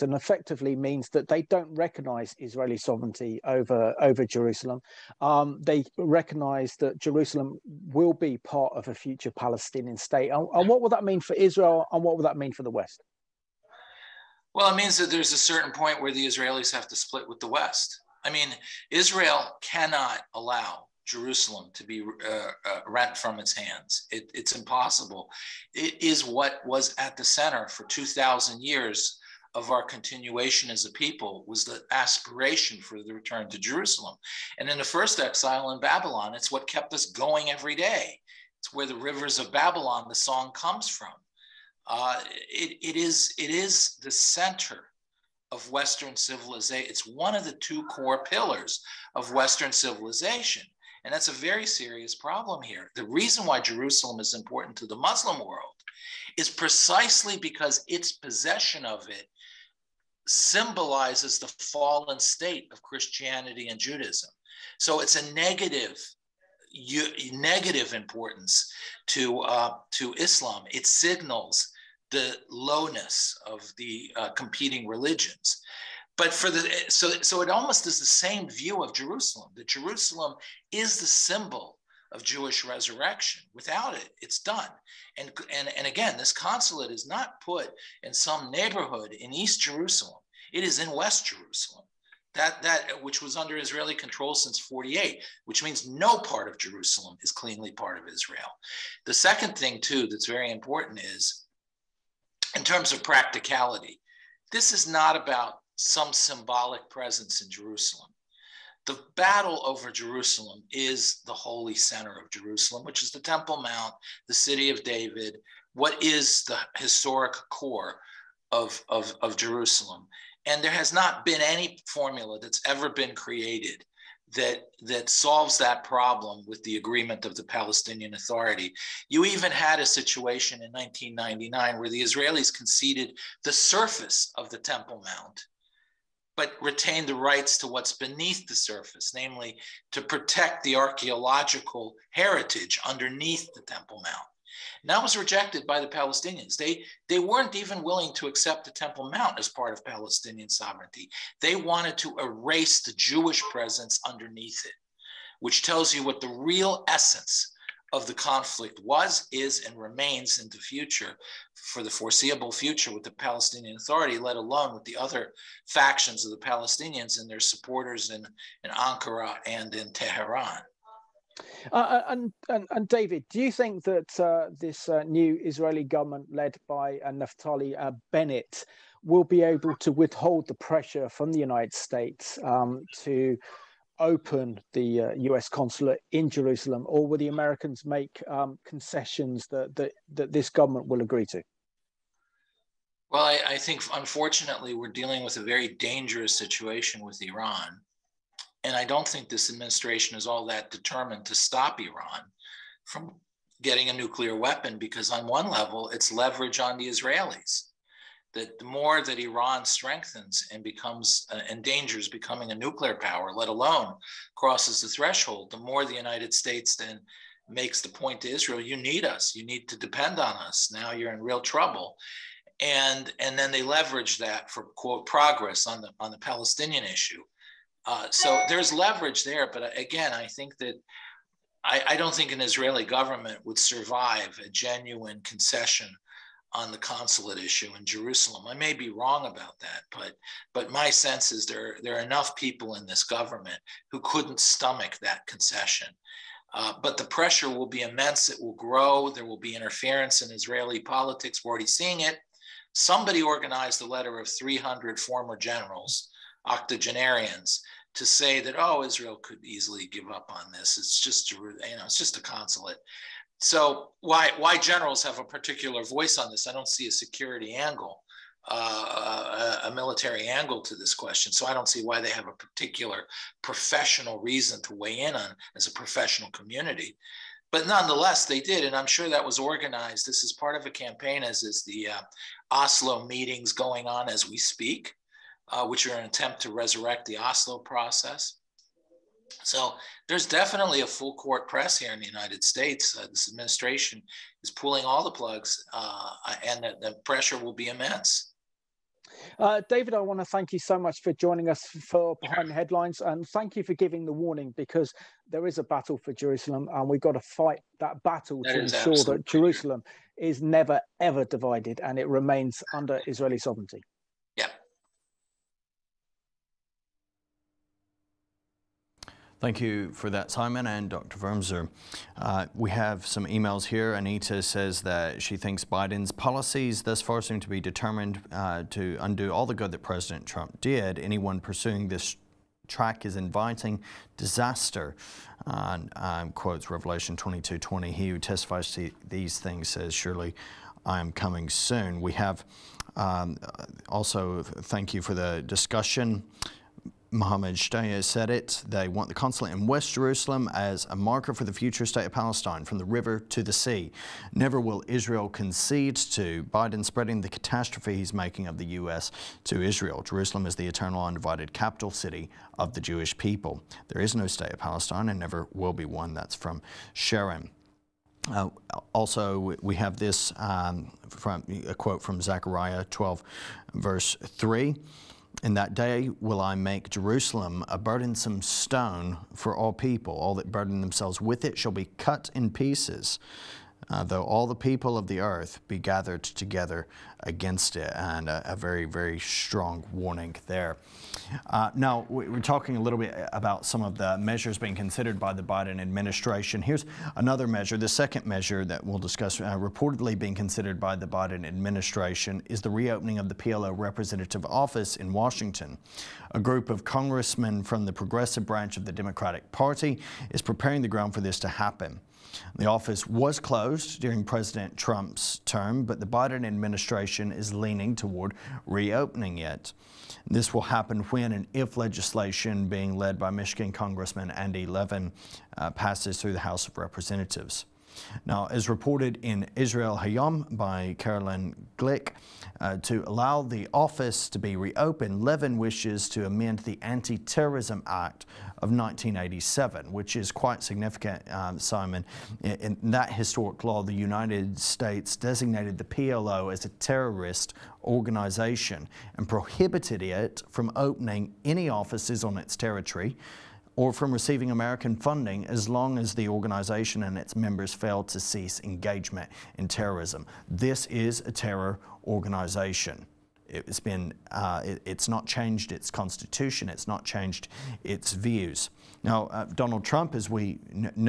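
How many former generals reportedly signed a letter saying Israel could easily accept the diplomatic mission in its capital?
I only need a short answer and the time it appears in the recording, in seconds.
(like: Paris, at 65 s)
300, at 254 s.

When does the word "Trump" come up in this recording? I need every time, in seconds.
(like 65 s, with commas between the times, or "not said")
330 s, 414 s, 469 s.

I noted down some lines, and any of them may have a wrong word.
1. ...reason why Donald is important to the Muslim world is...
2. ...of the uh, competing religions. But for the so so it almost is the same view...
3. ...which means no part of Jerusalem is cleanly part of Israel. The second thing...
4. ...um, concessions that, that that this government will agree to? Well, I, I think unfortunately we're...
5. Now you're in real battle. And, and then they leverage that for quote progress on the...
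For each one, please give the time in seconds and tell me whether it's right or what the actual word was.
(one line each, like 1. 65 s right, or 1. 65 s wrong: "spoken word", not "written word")
1. 53 s wrong: "Jerusalem", not "Donald"
2. 73 s right
3. 95 s right
4. 188 s right
5. 220 s wrong: "trouble", not "battle".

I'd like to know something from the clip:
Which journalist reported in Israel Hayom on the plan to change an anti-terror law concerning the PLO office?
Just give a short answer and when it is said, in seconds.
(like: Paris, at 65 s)
Caroline Glick, at 430 s.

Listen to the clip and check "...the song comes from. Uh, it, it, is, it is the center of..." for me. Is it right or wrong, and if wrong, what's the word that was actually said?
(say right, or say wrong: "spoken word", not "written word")
right.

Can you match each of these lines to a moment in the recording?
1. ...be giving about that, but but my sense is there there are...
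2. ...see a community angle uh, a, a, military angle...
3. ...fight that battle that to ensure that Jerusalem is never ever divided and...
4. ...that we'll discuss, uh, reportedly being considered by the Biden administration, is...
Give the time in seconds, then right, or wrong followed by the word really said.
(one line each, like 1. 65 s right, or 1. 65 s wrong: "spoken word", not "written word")
1. 238 s wrong: "wrong", not "giving"
2. 266 s wrong: "security", not "community"
3. 307 s right
4. 398 s right.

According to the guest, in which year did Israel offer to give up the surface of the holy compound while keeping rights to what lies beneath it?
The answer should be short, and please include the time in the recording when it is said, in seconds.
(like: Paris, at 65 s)
1999, at 130 s.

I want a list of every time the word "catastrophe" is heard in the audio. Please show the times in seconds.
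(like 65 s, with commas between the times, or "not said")
357 s.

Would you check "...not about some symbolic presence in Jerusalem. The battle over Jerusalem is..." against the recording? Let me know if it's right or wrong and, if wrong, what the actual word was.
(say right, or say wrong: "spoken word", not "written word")
right.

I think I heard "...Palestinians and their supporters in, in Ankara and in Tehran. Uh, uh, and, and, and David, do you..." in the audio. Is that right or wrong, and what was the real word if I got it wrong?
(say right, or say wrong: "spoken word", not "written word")
right.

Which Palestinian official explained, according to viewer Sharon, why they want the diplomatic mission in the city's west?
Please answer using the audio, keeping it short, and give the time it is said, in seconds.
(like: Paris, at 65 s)
Mohammed Shtayyeh, at 347 s.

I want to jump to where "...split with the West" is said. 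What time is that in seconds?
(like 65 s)
16 s.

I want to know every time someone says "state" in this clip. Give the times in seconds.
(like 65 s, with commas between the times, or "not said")
9 s, 62 s, 181 s, 216 s, 292 s, 351 s, 364 s, 444 s.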